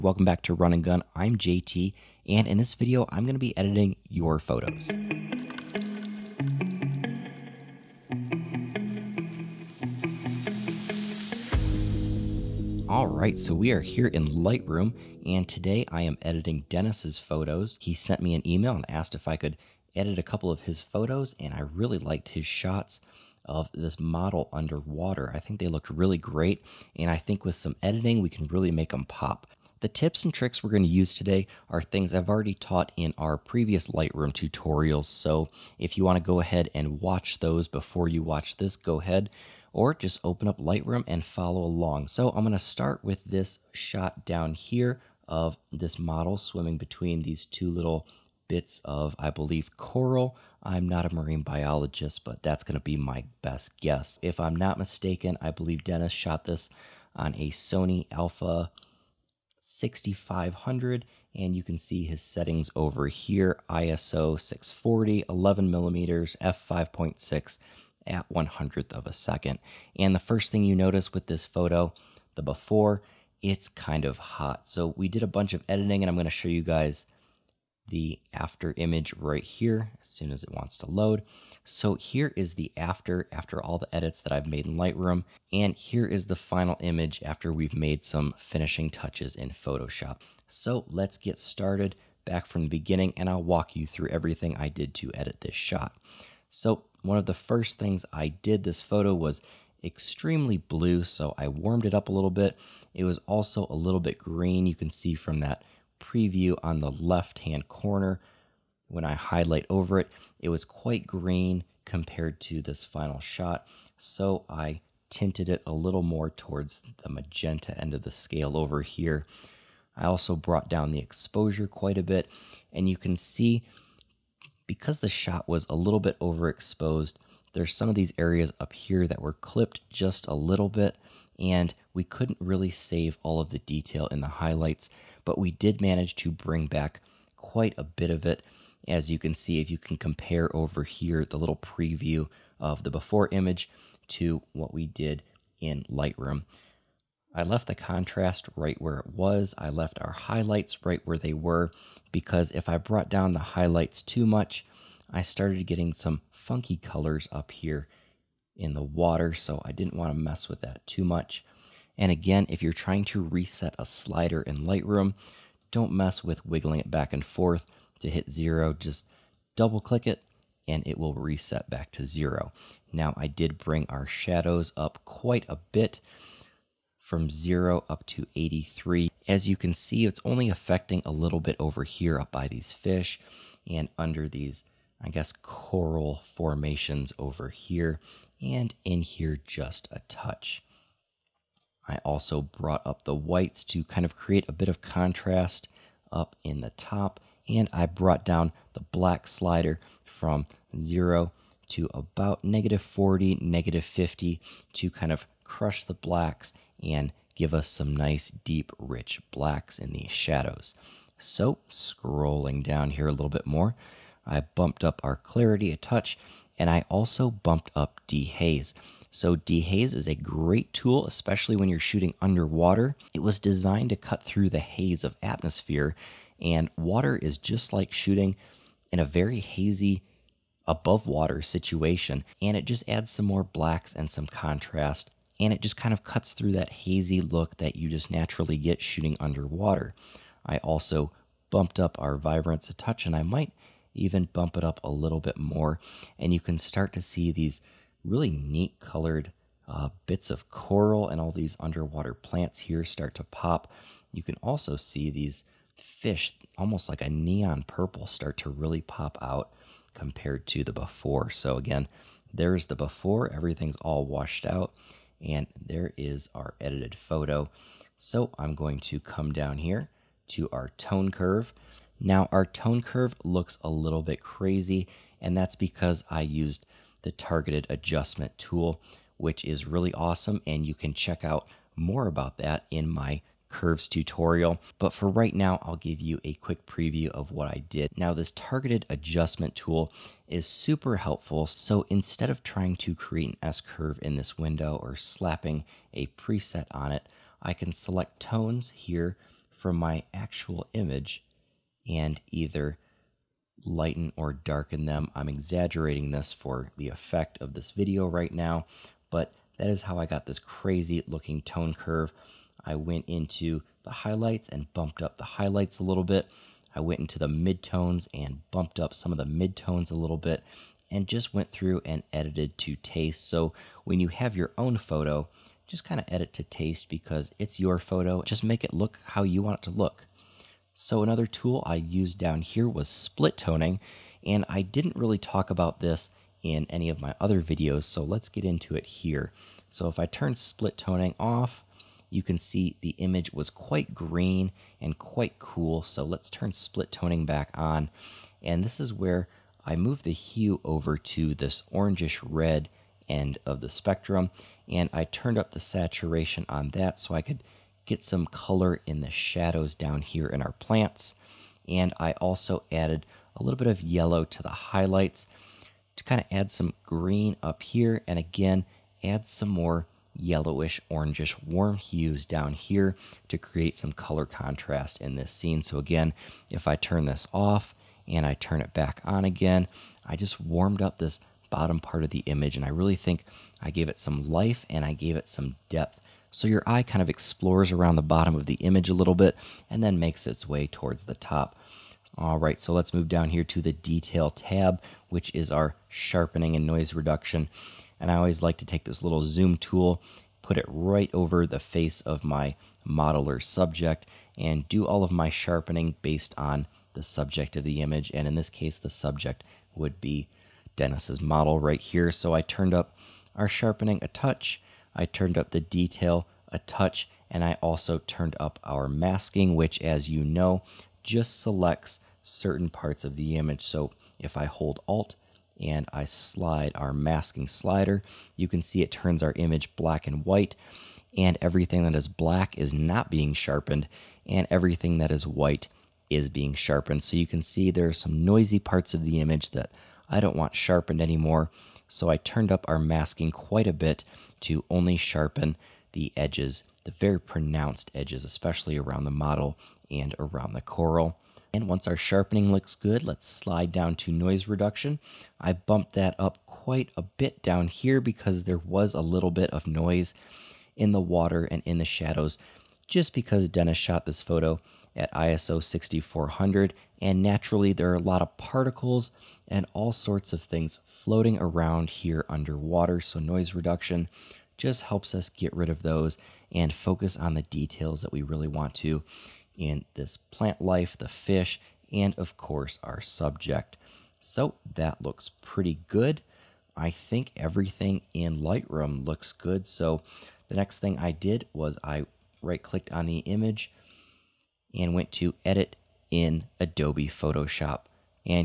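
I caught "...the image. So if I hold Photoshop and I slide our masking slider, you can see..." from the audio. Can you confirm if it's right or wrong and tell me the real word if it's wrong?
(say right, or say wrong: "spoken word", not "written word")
wrong: "Alt", not "Photoshop".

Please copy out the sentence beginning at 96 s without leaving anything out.
So one of the first things I did this photo was extremely blue, so I warmed it up a little bit.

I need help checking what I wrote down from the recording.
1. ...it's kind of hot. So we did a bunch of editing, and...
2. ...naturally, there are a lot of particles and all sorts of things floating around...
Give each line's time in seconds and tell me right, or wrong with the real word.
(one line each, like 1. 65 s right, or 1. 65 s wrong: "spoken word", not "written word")
1. 73 s right
2. 467 s right.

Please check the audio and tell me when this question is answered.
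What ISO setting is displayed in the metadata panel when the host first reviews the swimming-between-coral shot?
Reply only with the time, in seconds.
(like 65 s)
63 s.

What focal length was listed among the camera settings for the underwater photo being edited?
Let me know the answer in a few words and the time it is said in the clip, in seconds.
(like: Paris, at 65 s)
11 millimeters, at 65 s.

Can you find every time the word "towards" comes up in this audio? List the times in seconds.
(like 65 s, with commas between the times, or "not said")
116 s, 390 s.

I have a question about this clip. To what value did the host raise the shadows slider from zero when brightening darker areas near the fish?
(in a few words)
83.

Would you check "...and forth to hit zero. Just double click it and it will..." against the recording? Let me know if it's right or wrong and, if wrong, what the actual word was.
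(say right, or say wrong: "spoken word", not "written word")
right.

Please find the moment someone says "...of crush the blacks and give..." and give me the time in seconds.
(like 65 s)
205 s.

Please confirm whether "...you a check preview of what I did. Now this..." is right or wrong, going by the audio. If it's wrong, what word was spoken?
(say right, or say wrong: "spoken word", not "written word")
wrong: "quick", not "check".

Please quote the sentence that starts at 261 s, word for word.
So, again, there's the before, everything's all washed out, and there is our edited photo.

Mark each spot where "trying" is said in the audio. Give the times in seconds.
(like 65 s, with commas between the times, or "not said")
162 s, 292 s.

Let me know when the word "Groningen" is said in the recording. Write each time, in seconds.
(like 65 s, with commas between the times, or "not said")
not said.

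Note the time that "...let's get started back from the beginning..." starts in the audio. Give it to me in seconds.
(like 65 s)
90 s.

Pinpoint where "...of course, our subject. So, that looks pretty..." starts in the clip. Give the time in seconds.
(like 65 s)
482 s.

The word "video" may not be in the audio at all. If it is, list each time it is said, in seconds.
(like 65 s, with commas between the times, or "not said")
2 s, 307 s, 337 s.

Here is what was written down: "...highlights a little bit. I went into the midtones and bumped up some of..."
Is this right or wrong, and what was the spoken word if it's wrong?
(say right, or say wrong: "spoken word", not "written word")
right.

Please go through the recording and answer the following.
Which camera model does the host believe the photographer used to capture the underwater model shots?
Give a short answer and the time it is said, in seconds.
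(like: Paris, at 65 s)
Sony Alpha 6500, at 57 s.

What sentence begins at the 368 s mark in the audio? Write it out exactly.
And again, add some more yellowish, orangish, warm hues down here to create some color contrast in this scene.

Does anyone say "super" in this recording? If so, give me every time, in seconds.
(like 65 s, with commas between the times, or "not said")
290 s.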